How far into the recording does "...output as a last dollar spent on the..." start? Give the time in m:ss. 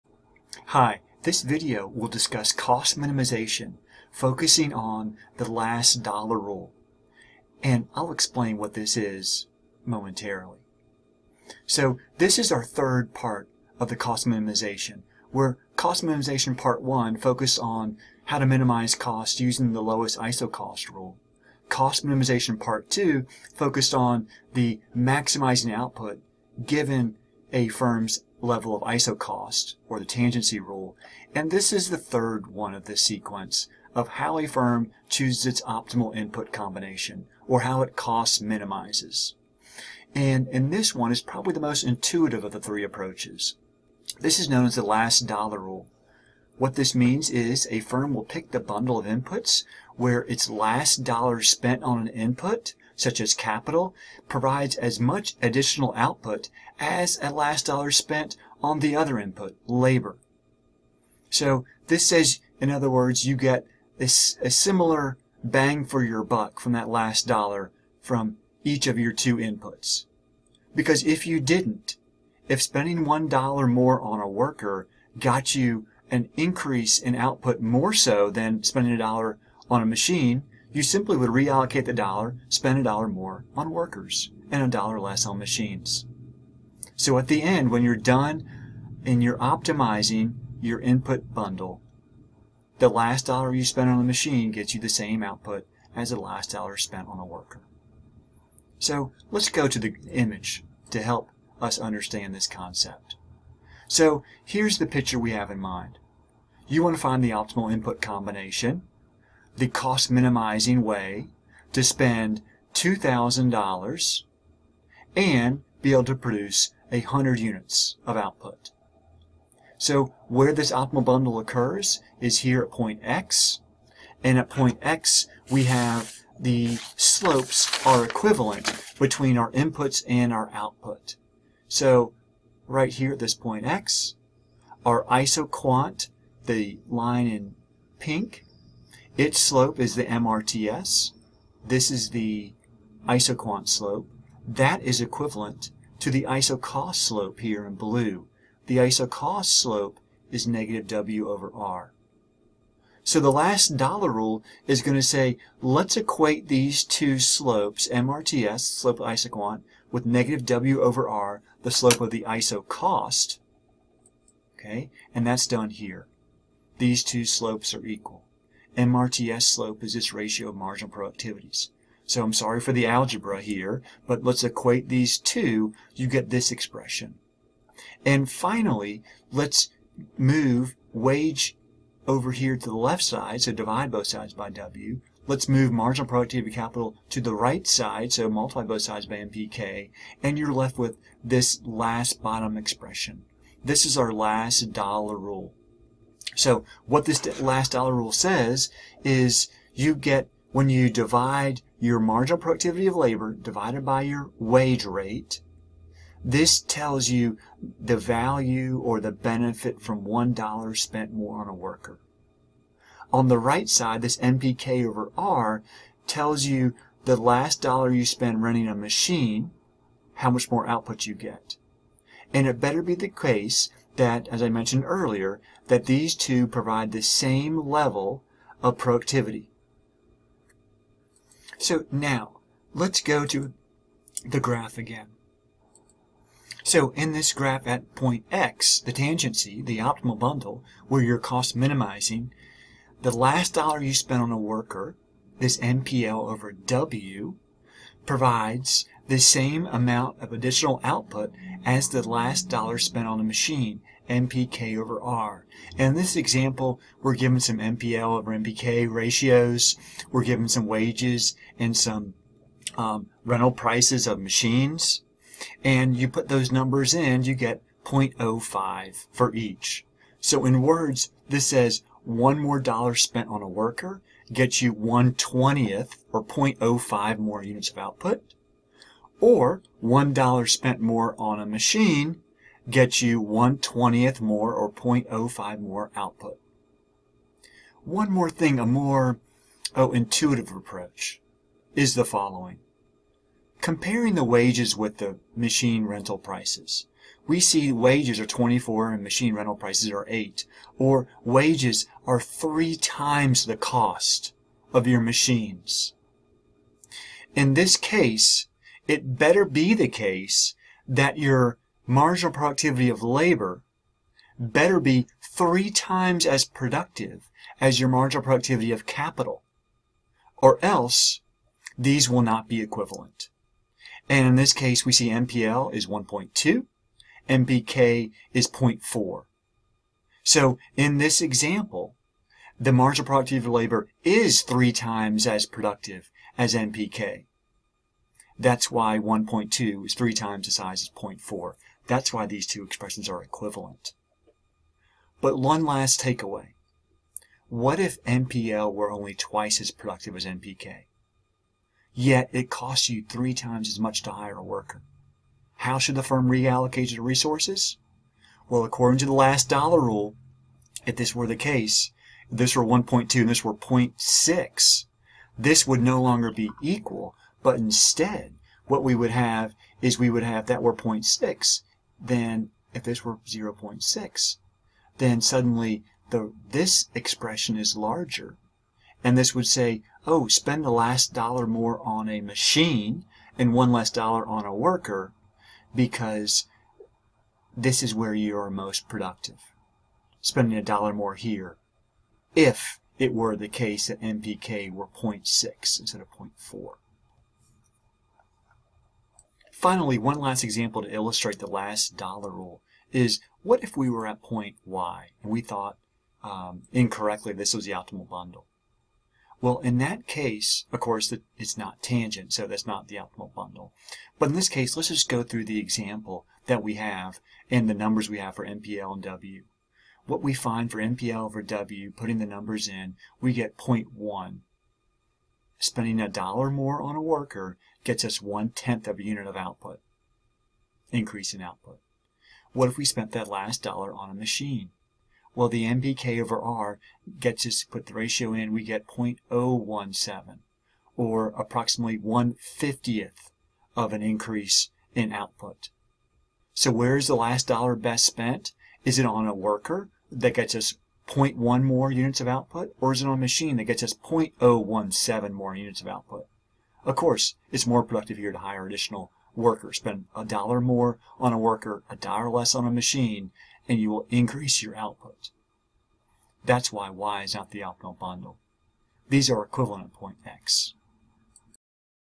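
0:55.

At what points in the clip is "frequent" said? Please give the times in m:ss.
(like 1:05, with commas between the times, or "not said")
not said.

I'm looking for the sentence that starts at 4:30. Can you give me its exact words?
So in words, this says one more dollar spent on a worker gets you 1 20th or 0.05 more units of output.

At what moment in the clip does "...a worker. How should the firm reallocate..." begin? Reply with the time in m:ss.
5:54.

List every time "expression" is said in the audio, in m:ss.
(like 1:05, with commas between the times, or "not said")
2:56, 3:12, 5:42, 6:16.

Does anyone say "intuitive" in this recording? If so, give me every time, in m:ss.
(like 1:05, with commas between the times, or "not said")
0:41, 4:49.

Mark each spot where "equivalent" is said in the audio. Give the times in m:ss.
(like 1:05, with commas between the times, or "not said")
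2:08, 2:25, 5:22, 5:43, 7:49.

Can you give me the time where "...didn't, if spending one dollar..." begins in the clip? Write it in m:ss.
1:11.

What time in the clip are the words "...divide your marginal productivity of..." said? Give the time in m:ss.
3:20.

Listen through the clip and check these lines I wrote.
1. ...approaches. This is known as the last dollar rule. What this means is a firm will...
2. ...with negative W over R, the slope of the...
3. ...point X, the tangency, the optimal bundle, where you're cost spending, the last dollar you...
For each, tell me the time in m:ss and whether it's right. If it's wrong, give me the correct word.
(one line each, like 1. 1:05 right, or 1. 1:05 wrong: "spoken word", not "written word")
1. 0:42 right
2. 2:39 right
3. 3:57 wrong: "minimizing", not "spending".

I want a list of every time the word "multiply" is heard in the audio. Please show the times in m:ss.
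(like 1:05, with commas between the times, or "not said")
3:08.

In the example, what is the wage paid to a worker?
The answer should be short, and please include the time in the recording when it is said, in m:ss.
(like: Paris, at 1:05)
24, at 4:58.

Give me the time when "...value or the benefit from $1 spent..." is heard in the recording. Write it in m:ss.
3:27.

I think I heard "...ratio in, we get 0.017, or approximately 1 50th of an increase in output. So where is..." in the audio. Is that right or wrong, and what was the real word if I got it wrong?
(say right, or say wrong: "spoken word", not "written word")
right.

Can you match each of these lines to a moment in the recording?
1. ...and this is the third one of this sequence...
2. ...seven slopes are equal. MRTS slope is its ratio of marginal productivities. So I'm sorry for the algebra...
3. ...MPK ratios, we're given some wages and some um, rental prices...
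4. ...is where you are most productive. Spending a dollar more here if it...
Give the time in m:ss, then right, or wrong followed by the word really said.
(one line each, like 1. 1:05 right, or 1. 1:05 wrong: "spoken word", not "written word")
1. 0:31 right
2. 2:47 wrong: "two", not "seven"
3. 4:18 right
4. 6:27 right.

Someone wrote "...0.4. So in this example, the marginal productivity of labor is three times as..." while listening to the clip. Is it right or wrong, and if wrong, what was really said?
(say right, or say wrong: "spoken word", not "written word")
right.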